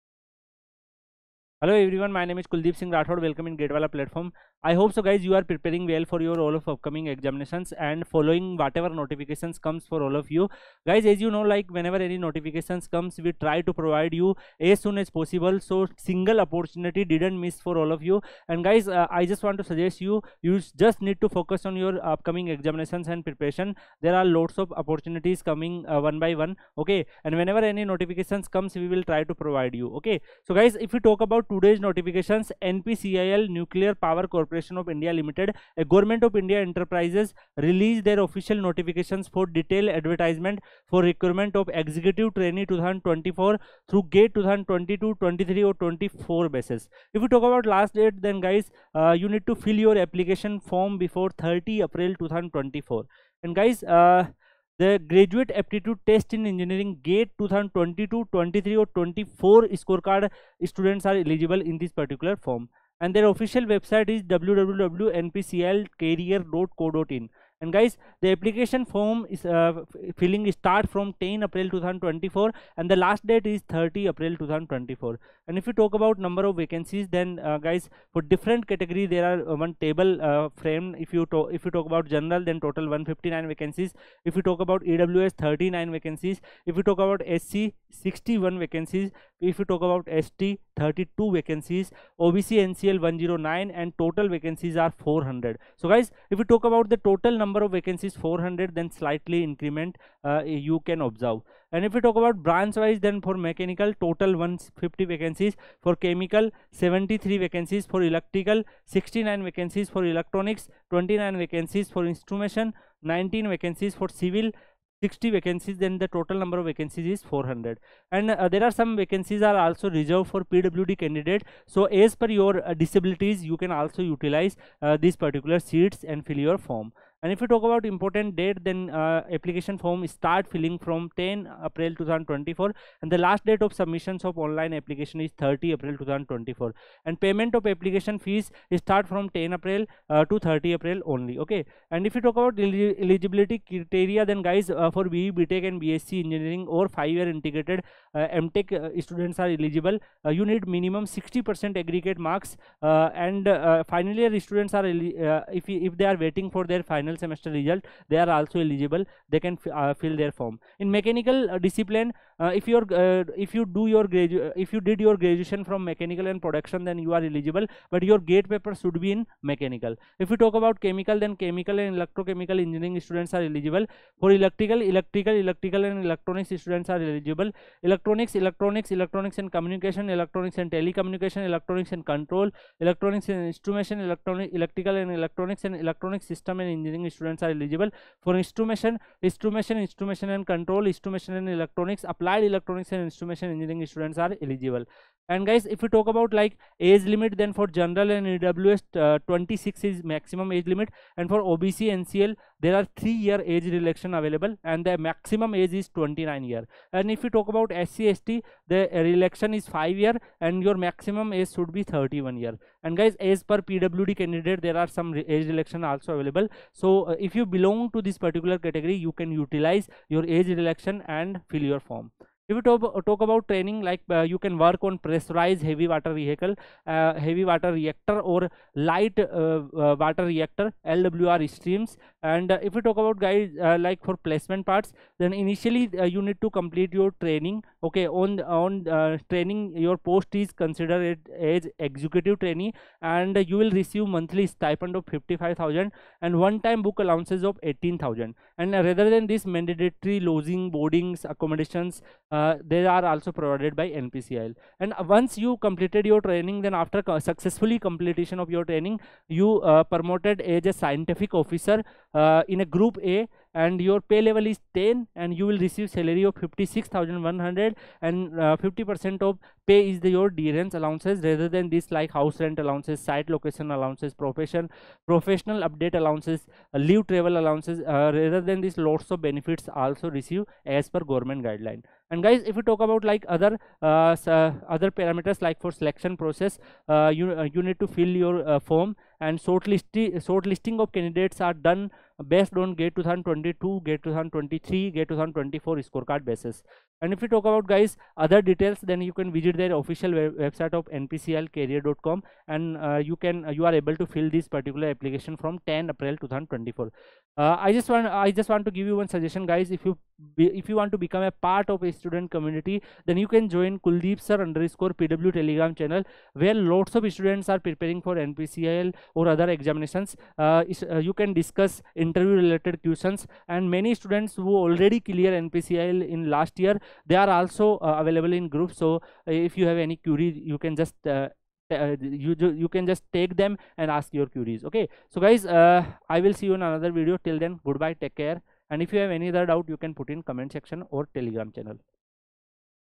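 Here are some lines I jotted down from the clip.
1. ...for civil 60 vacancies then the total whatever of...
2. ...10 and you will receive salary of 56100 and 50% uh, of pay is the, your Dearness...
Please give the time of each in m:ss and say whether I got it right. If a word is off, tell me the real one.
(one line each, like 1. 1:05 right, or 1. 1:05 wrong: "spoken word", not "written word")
1. 1:53 wrong: "number", not "whatever"
2. 4:24 right.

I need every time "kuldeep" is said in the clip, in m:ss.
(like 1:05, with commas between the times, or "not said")
0:02, 5:13.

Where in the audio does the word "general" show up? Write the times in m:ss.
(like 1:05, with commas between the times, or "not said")
1:22, 3:17.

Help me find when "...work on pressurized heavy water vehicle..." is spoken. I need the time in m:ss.
3:44.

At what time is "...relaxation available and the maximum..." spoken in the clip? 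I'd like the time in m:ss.
3:23.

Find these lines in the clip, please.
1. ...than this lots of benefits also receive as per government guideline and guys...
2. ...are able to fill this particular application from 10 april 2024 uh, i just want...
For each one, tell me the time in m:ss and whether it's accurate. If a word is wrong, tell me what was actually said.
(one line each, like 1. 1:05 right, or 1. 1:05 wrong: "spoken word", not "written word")
1. 4:38 right
2. 5:03 right.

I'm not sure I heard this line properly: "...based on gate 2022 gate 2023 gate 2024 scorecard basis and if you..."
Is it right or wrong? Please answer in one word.
right.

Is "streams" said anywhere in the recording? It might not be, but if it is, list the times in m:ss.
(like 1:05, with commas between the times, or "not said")
3:51.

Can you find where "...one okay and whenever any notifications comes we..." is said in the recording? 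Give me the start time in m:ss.
0:26.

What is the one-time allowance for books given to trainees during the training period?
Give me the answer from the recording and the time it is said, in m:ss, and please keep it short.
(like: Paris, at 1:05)
18000, at 4:06.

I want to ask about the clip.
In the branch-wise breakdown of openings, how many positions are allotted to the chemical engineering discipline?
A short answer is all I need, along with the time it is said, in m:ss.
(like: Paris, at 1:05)
73, at 1:45.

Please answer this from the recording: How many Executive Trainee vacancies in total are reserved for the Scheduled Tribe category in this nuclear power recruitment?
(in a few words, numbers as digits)
32.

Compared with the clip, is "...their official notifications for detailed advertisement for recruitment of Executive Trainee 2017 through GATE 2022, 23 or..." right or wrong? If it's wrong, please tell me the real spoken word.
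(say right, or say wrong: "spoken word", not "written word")
wrong: "2024", not "2017".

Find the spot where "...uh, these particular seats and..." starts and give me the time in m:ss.
2:04.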